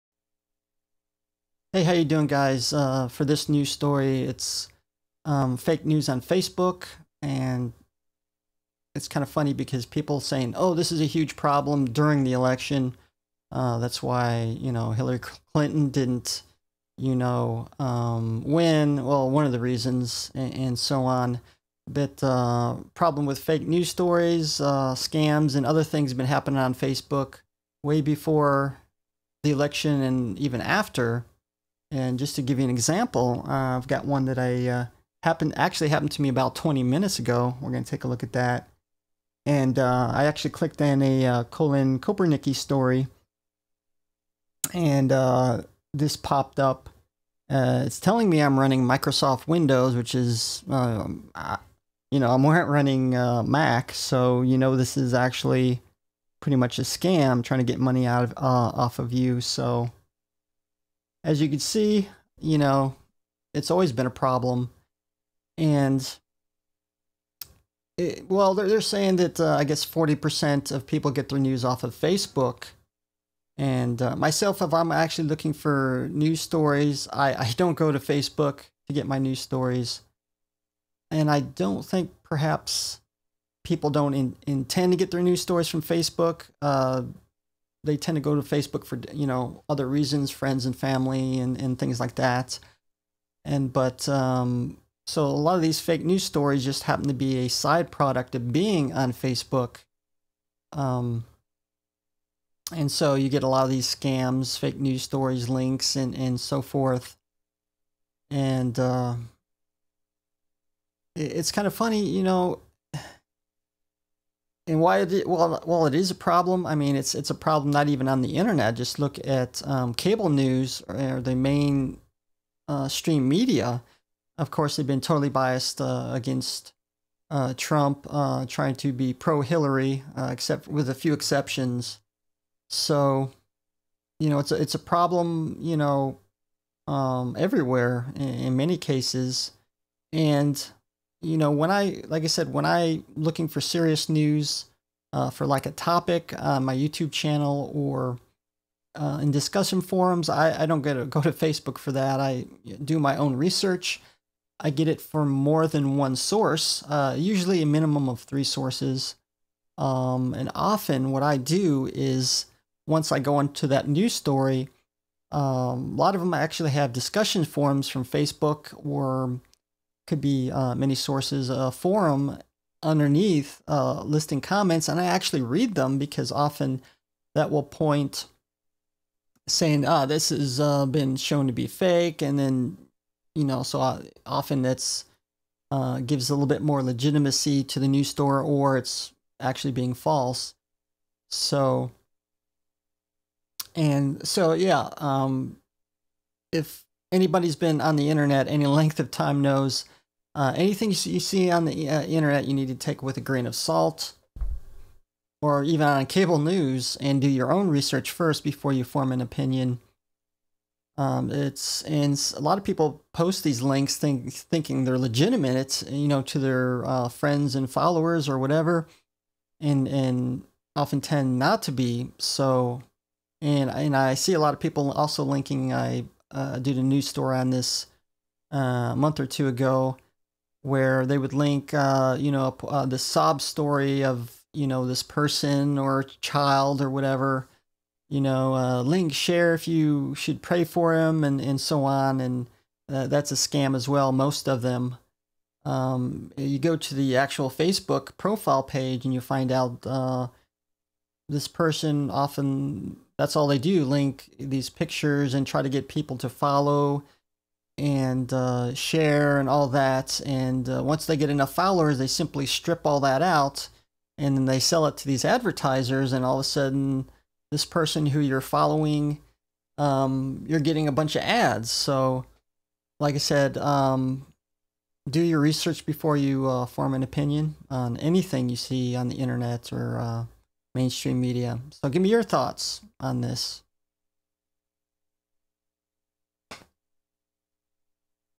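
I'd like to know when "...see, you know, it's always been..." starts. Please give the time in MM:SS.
01:01.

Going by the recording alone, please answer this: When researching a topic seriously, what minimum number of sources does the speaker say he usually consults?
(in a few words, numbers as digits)
3.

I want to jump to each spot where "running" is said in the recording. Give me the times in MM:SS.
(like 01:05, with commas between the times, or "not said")
00:48, 00:52.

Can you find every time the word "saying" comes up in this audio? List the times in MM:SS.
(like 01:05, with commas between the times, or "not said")
00:10, 01:08, 02:59.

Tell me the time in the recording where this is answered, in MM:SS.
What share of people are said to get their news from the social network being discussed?
01:09.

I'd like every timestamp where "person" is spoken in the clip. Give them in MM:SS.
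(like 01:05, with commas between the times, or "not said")
03:55, 04:11, 04:27.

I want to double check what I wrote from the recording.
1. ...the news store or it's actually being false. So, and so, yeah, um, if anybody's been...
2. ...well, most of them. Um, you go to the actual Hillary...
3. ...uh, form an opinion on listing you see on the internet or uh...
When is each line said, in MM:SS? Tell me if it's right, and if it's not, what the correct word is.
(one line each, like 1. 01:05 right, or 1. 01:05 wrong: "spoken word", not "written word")
1. 03:07 right
2. 04:03 wrong: "Facebook", not "Hillary"
3. 04:36 wrong: "anything", not "listing".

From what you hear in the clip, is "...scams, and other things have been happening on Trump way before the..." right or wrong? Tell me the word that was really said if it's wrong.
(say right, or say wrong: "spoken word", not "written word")
wrong: "Facebook", not "Trump".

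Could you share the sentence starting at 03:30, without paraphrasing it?
Um, it's and a lot of people post these links think, thinking they're legitimate.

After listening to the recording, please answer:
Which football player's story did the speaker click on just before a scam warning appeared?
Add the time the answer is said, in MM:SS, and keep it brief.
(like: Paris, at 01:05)
Colin Kaepernick, at 00:41.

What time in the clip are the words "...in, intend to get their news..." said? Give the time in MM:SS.
01:24.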